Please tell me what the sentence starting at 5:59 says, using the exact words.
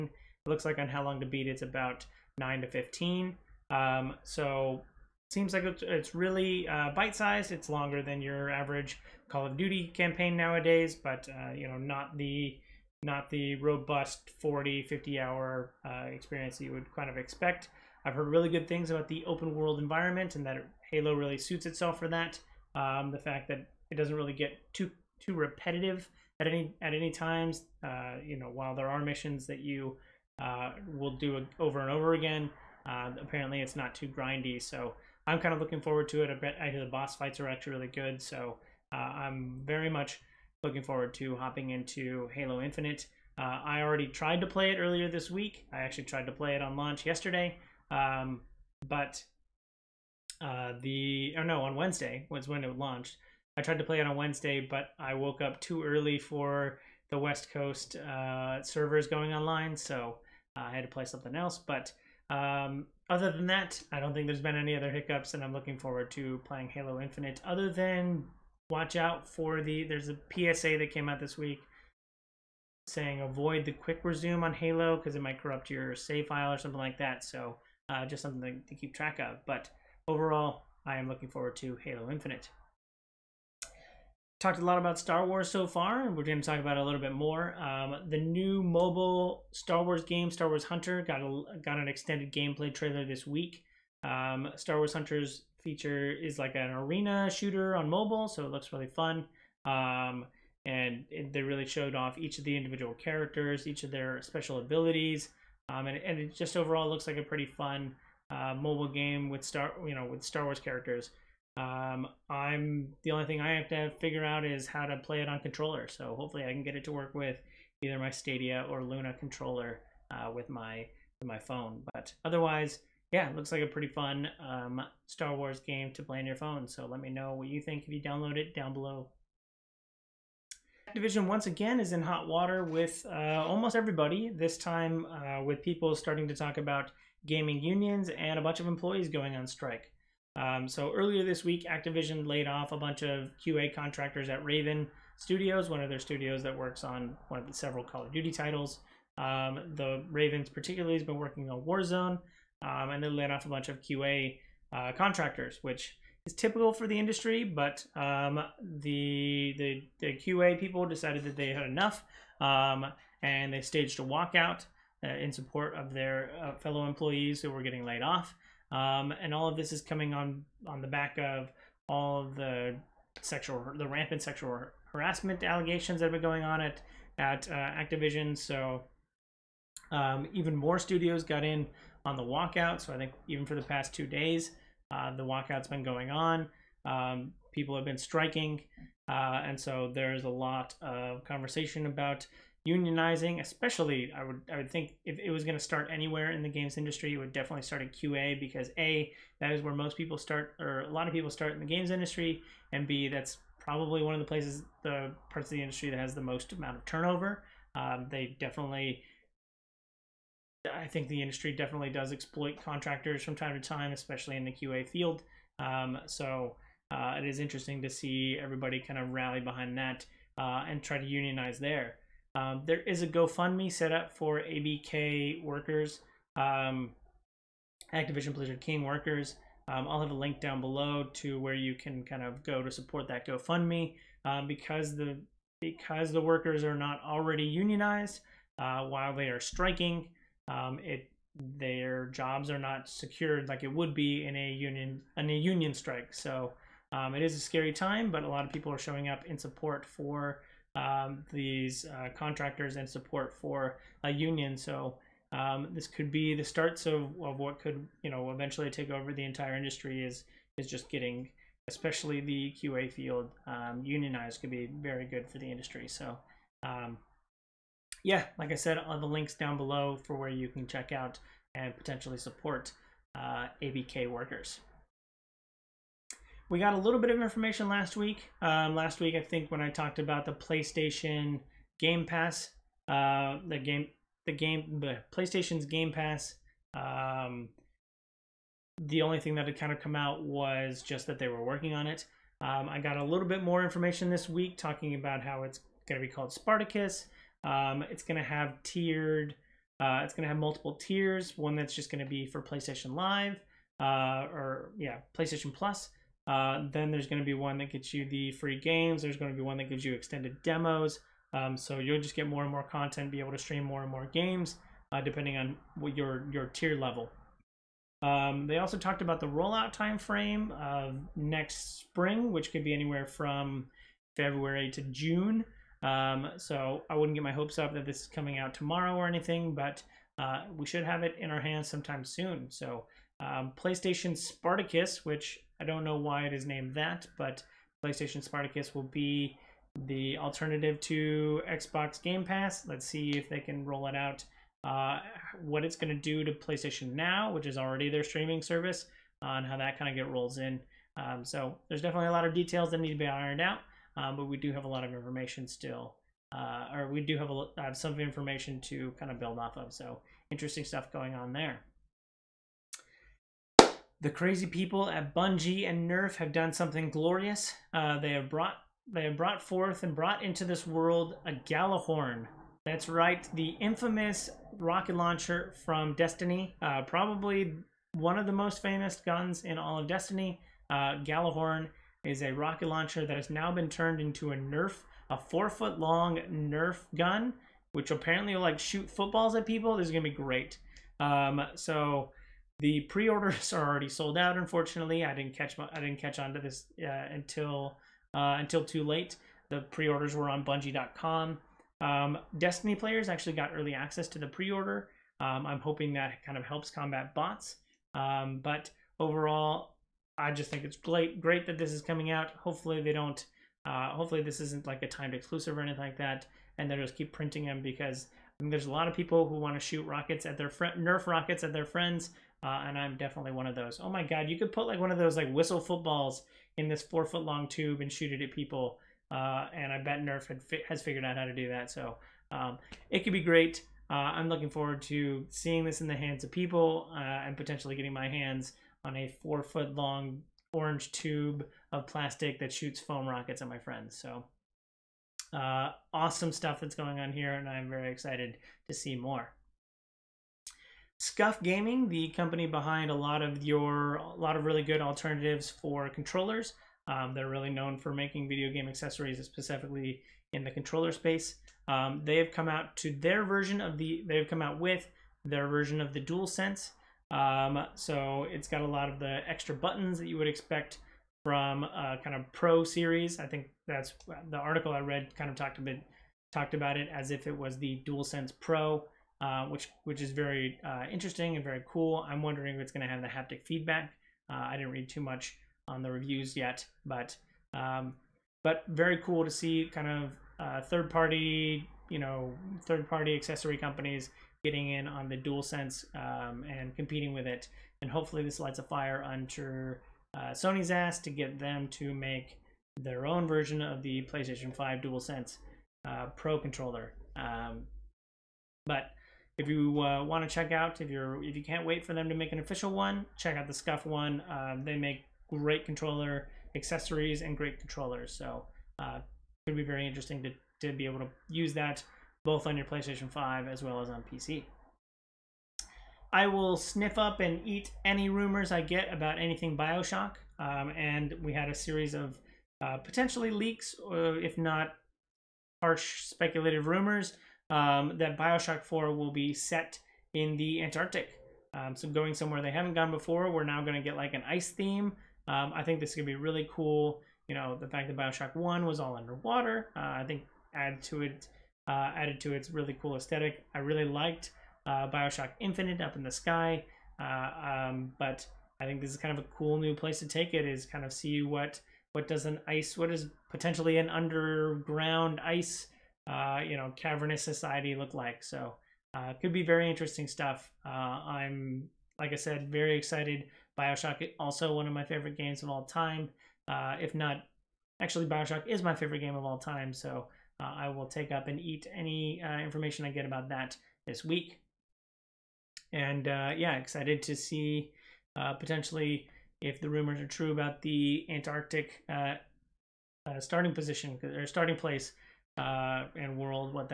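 So interesting stuff going on there.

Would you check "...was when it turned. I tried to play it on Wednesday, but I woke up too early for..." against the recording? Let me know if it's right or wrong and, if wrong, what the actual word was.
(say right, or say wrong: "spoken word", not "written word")
wrong: "launched", not "turned".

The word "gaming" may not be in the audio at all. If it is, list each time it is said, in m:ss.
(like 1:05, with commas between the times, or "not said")
2:17, 7:31.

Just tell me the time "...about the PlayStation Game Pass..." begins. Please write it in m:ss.
4:39.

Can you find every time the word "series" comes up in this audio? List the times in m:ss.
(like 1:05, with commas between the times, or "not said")
7:52, 8:51.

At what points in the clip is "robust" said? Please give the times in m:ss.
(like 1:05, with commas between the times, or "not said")
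0:13.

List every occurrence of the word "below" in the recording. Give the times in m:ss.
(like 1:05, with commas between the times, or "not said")
2:08, 3:50, 4:29.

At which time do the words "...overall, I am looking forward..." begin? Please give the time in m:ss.
1:20.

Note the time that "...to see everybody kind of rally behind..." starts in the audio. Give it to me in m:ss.
3:37.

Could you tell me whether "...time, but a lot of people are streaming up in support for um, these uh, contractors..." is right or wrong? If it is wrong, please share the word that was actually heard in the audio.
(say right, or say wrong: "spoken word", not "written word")
wrong: "showing", not "streaming".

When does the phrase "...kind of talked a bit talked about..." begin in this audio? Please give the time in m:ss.
7:55.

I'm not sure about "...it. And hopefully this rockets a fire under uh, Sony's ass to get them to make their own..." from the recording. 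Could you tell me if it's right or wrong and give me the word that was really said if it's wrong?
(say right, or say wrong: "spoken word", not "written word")
wrong: "lights", not "rockets".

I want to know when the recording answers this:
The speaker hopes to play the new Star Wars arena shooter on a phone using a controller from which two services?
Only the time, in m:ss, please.
1:58.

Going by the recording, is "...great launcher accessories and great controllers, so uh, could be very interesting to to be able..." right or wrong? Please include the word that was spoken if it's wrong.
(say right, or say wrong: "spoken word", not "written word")
wrong: "controller", not "launcher".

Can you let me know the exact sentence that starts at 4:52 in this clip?
Um, I got a little bit more information this week talking about how it's going to be called Spartacus.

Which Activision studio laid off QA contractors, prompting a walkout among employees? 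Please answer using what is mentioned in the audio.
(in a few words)
Raven Studios.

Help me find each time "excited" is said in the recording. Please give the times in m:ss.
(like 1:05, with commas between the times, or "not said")
7:27, 9:32, 9:46.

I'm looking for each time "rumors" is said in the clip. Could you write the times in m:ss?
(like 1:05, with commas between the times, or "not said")
8:48, 8:56, 9:49.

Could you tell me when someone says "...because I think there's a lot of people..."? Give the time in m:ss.
6:57.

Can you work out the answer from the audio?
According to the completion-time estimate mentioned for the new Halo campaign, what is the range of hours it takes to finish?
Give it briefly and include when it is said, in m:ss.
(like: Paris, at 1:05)
9 to 15, at 0:02.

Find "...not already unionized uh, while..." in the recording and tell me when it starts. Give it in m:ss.
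3:56.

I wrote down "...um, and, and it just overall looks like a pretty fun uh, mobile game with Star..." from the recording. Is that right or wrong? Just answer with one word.
right.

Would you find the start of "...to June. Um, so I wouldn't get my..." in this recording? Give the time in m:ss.
5:24.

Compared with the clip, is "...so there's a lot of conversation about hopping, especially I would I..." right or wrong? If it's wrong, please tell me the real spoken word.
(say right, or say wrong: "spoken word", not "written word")
wrong: "unionizing", not "hopping".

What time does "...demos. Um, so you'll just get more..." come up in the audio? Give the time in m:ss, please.
5:10.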